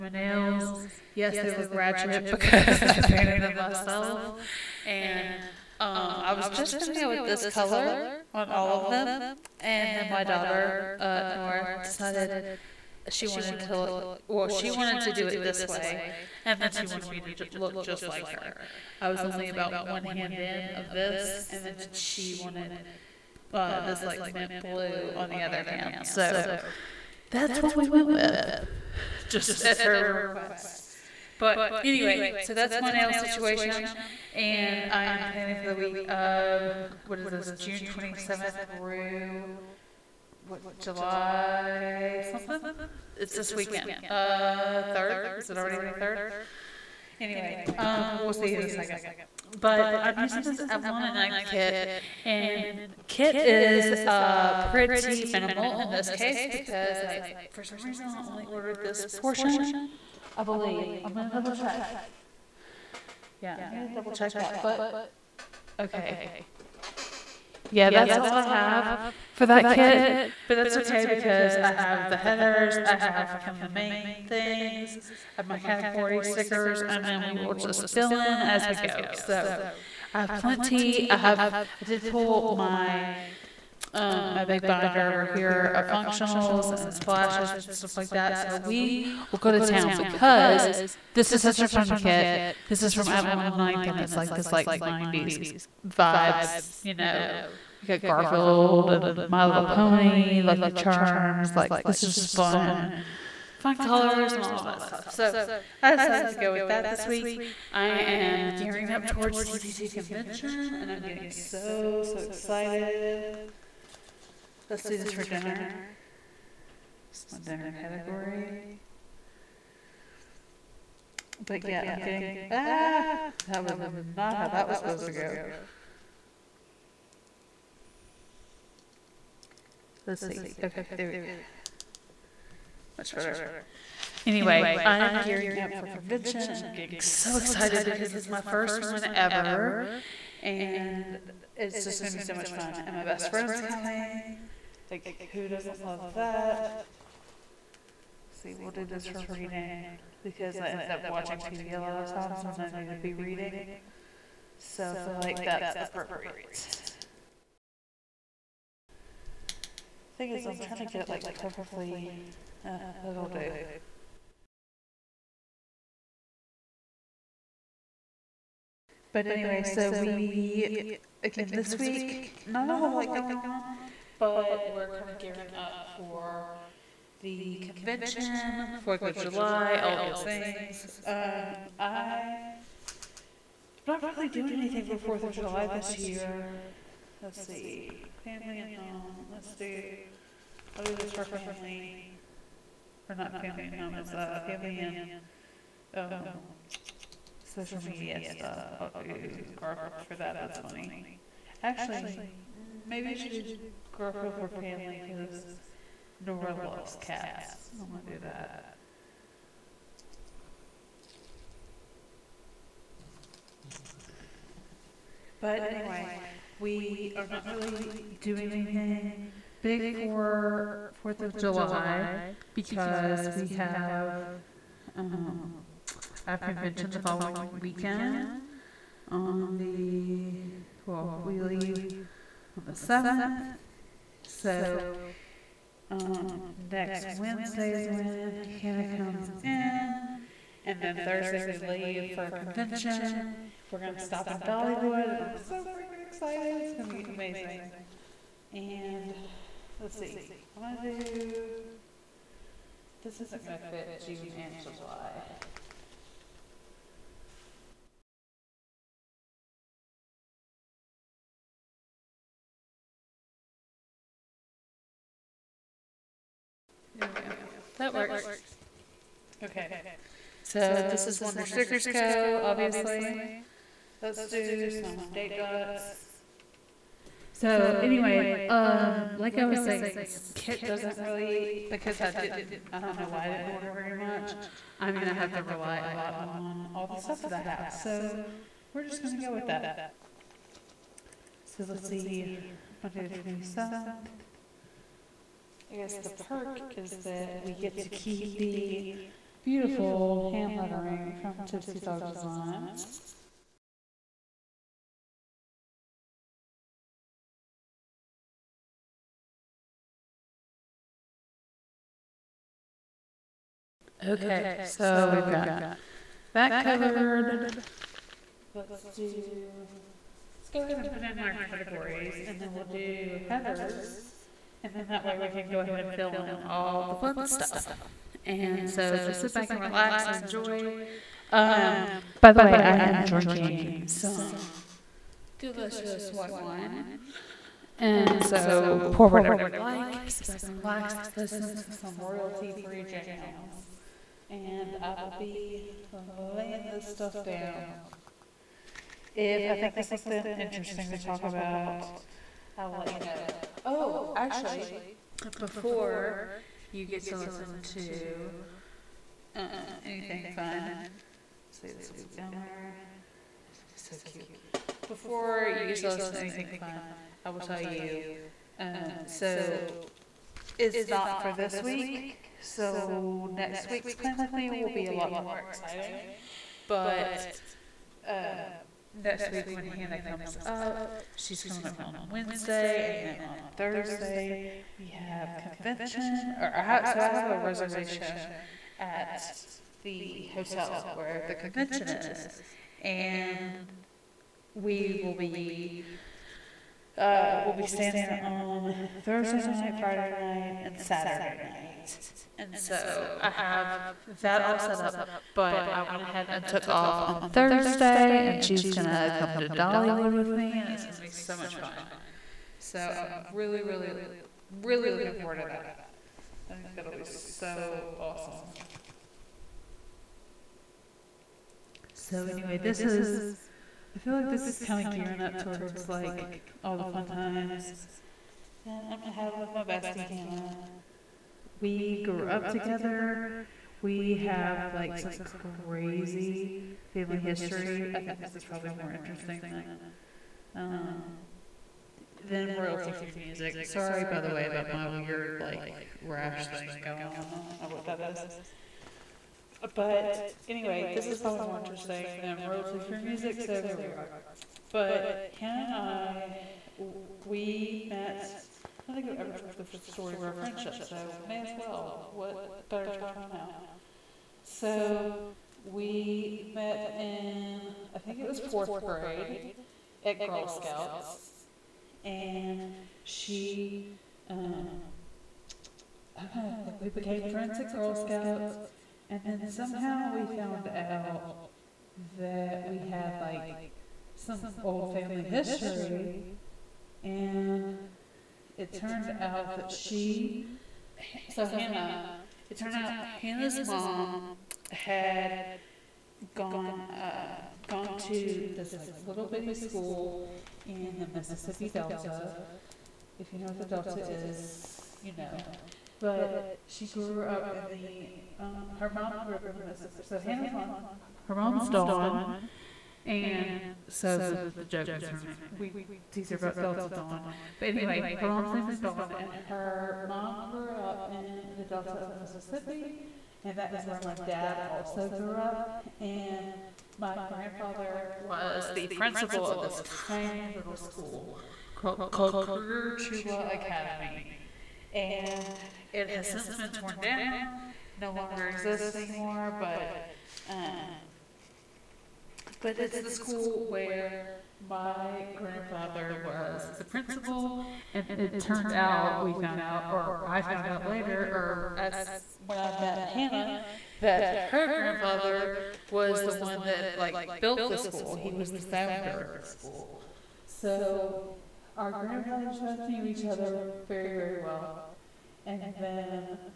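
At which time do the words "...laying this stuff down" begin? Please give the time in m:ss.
5:46.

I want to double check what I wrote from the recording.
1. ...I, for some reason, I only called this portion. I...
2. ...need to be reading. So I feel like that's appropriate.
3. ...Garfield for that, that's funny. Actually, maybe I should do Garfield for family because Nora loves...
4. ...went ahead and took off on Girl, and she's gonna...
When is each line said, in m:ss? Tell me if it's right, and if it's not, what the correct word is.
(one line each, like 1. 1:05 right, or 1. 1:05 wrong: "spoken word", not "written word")
1. 0:57 wrong: "ordered", not "called"
2. 2:32 right
3. 3:19 right
4. 6:45 wrong: "Thursday", not "Girl".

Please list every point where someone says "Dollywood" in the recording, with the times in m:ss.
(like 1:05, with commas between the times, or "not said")
4:04, 6:49.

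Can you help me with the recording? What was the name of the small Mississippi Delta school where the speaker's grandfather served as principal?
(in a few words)
Cruger-Tchula Academy.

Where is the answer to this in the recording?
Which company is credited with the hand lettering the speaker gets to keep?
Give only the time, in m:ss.
5:01.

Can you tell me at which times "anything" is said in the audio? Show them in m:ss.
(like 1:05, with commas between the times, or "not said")
3:04, 3:38, 5:59, 6:06.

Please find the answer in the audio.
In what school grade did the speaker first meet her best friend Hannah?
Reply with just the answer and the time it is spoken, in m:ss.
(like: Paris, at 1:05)
fourth grade, at 7:48.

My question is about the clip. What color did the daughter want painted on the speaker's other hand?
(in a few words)
mint blue.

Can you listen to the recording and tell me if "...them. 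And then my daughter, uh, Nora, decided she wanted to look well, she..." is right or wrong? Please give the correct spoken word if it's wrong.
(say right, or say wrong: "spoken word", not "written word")
right.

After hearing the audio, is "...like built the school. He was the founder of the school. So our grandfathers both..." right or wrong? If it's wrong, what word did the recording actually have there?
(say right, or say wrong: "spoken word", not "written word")
right.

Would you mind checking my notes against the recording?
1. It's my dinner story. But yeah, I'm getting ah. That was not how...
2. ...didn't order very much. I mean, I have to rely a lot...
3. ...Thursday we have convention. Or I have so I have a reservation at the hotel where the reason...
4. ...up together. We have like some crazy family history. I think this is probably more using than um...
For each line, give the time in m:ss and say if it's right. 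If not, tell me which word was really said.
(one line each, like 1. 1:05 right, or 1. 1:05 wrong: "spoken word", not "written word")
1. 1:57 wrong: "category", not "story"
2. 4:43 right
3. 6:23 wrong: "convention", not "reason"
4. 7:12 wrong: "interesting", not "using".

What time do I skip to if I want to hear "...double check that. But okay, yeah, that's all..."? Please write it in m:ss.
1:03.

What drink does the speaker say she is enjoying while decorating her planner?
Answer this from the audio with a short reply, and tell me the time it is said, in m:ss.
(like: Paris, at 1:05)
white wine, at 5:36.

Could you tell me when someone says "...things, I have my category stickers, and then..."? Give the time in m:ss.
1:14.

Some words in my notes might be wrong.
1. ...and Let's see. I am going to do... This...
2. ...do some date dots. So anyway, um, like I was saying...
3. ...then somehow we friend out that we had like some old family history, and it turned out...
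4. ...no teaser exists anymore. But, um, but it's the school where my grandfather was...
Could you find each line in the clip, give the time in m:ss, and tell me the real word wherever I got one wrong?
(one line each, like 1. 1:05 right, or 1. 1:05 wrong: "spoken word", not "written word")
1. 4:08 right
2. 4:34 right
3. 7:59 wrong: "found", not "friend"
4. 8:58 wrong: "longer", not "teaser".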